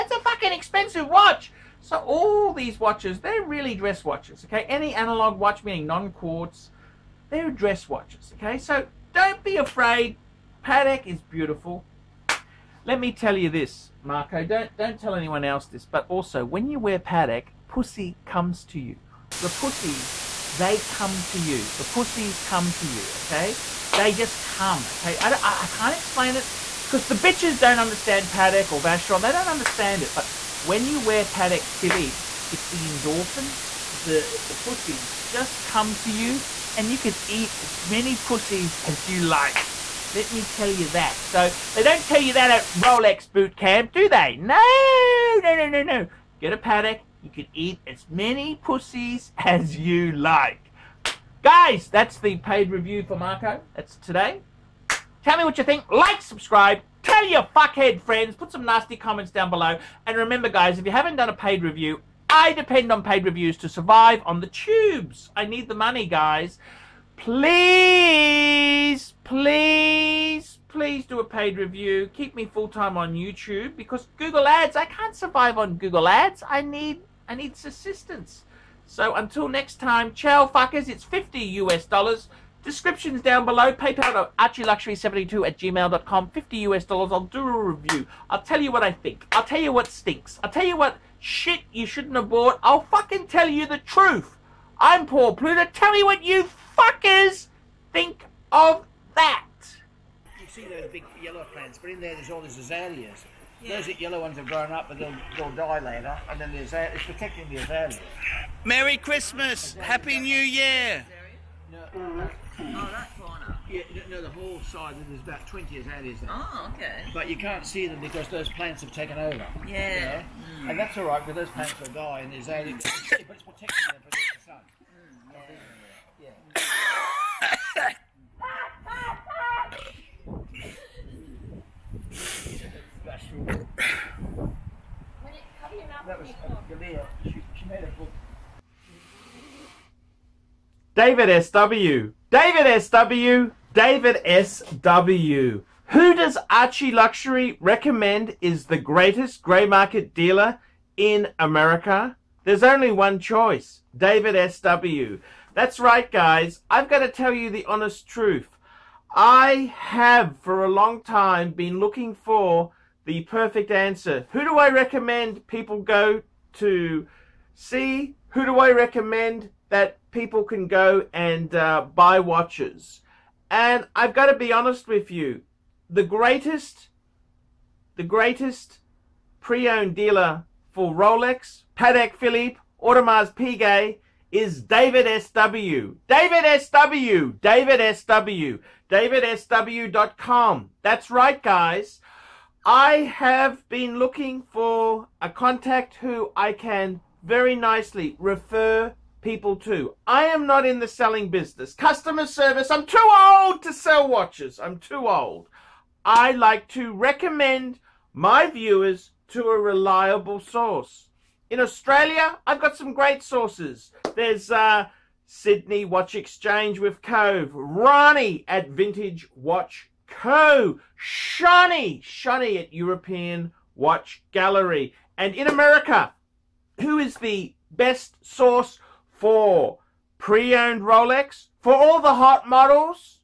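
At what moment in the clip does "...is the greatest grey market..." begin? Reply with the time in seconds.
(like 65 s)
148 s.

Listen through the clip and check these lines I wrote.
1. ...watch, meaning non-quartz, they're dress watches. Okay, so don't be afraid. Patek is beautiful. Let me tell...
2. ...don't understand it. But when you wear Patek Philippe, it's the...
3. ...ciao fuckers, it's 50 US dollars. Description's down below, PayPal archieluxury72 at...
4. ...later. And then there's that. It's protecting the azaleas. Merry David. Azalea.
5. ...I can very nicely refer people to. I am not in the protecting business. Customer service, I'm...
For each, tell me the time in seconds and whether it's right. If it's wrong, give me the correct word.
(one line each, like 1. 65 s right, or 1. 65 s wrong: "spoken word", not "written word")
1. 5 s right
2. 29 s right
3. 80 s right
4. 105 s wrong: "Christmas", not "David"
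5. 196 s wrong: "selling", not "protecting".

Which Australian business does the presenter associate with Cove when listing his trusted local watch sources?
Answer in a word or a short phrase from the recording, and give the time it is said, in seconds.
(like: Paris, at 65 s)
Sydney Watch Exchange, at 215 s.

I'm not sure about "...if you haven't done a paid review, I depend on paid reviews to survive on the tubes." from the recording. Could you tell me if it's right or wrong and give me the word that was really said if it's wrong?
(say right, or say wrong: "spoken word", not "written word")
right.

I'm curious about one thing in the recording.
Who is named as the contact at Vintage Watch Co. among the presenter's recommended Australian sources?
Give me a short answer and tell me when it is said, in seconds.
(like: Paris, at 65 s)
Rani, at 217 s.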